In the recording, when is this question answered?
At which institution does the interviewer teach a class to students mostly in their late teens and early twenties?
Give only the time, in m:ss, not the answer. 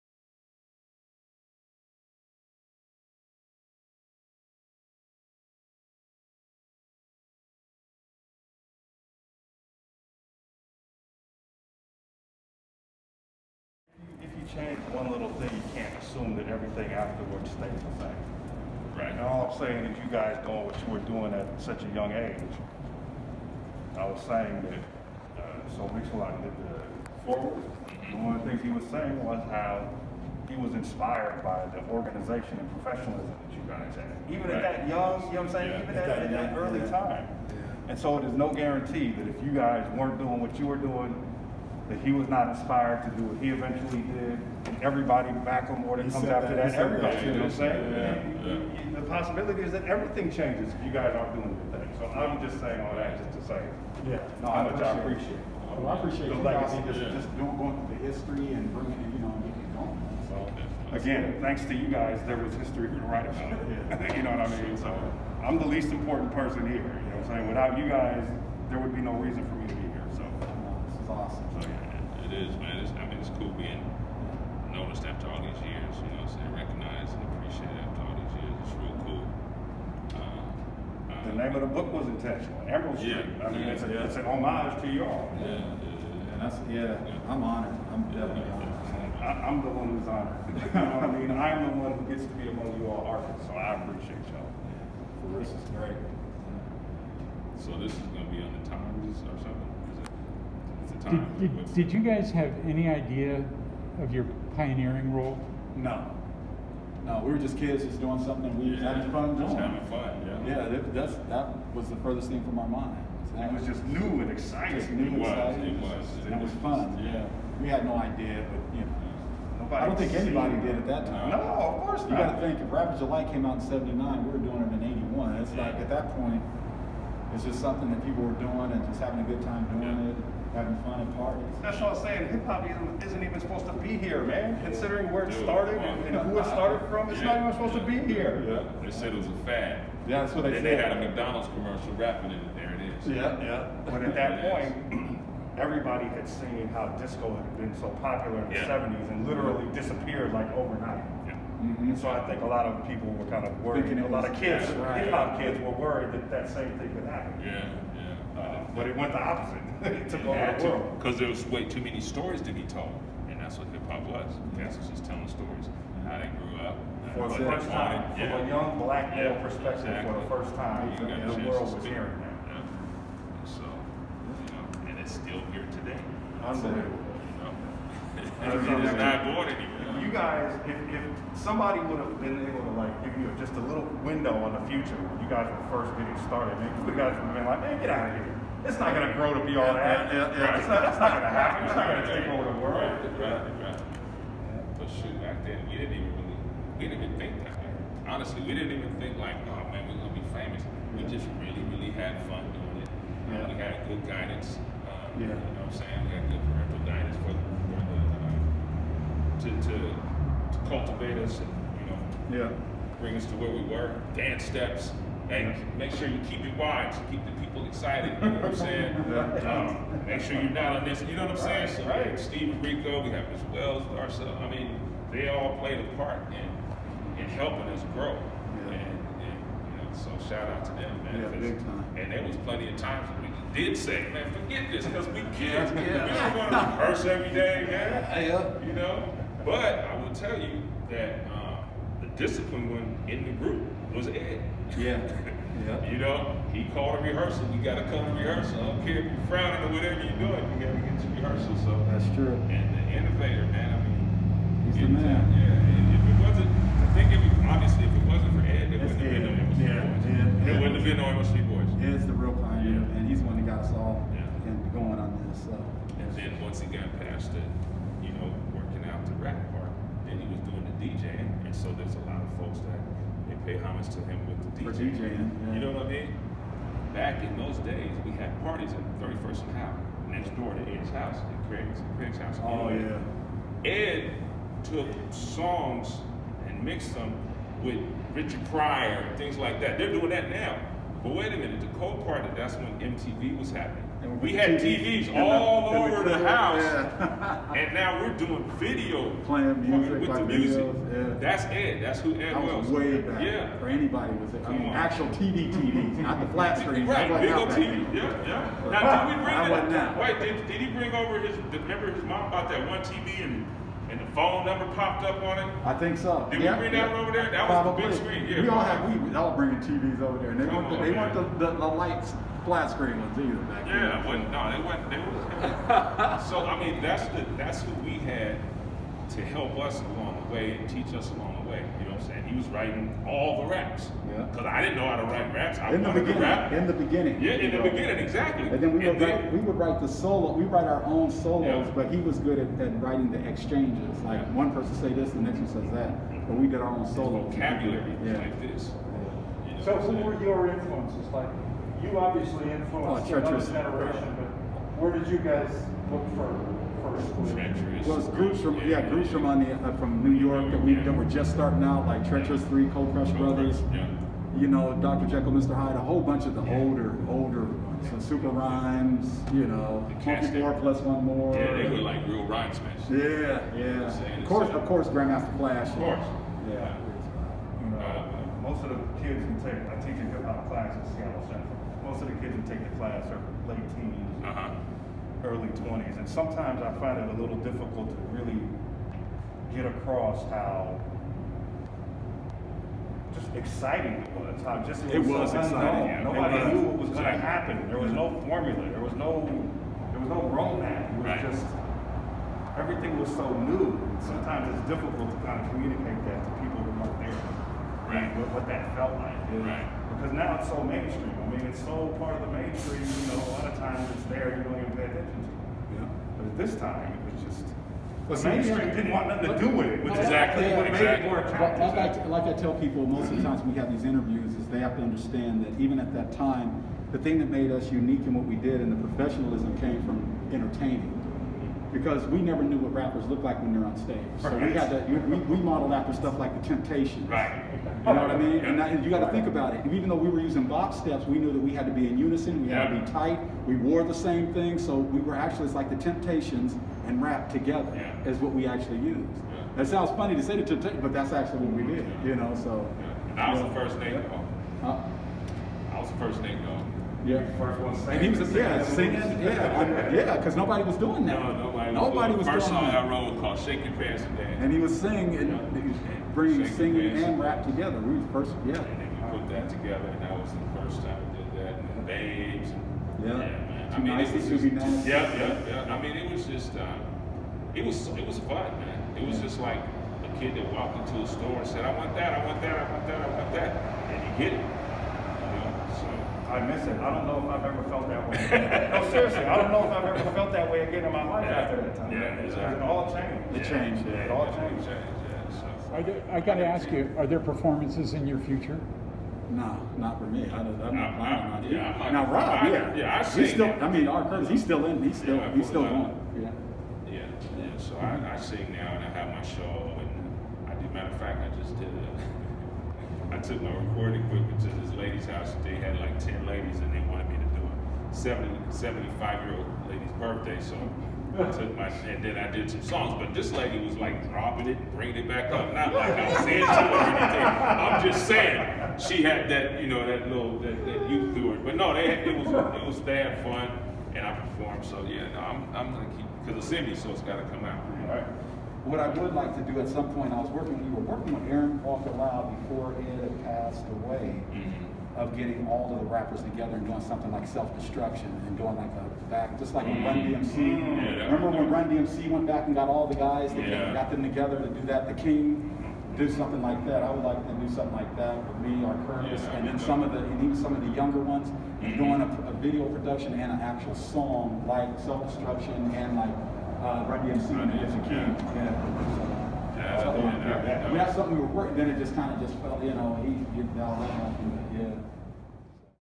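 6:20.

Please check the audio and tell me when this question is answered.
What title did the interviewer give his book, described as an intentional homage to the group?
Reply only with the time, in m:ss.
1:22.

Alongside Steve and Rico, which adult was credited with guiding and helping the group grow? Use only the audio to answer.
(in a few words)
Miss Wells.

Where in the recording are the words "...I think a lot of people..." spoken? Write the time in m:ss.
2:32.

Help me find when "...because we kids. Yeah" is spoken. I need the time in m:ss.
3:54.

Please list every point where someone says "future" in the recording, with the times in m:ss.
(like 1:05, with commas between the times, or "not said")
3:04, 8:18.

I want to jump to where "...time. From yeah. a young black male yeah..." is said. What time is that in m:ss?
2:47.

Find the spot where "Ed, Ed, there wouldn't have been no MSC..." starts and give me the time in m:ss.
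4:19.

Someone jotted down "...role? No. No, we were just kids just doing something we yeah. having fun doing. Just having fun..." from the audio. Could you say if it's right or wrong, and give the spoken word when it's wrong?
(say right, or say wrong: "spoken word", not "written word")
right.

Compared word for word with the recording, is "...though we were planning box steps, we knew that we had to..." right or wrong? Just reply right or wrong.
wrong.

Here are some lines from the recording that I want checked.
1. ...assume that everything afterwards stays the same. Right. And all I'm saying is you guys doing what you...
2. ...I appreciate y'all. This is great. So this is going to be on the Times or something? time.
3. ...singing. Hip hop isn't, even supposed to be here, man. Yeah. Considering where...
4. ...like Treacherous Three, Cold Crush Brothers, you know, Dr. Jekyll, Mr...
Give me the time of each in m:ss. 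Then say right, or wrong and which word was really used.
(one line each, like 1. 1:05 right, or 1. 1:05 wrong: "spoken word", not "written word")
1. 0:16 right
2. 1:33 right
3. 2:12 wrong: "saying", not "singing"
4. 6:01 right.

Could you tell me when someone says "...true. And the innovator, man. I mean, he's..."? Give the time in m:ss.
4:12.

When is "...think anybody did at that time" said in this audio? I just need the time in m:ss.
1:59.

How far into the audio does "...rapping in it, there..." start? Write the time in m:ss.
2:21.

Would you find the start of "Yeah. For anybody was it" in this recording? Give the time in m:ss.
5:03.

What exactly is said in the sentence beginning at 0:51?
So I'm just saying all that just to say yeah.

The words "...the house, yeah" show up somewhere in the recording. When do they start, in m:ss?
4:56.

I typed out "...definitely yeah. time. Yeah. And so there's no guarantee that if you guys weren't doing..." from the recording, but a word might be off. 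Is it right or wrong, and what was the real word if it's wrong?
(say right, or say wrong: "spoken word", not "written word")
wrong: "early", not "definitely".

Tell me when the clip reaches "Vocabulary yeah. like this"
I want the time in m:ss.
5:47.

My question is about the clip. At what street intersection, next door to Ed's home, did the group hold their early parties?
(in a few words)
31st and Howard.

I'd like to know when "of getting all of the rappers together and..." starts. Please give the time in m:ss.
9:05.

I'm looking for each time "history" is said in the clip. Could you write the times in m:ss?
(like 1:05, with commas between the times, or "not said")
0:58, 1:02.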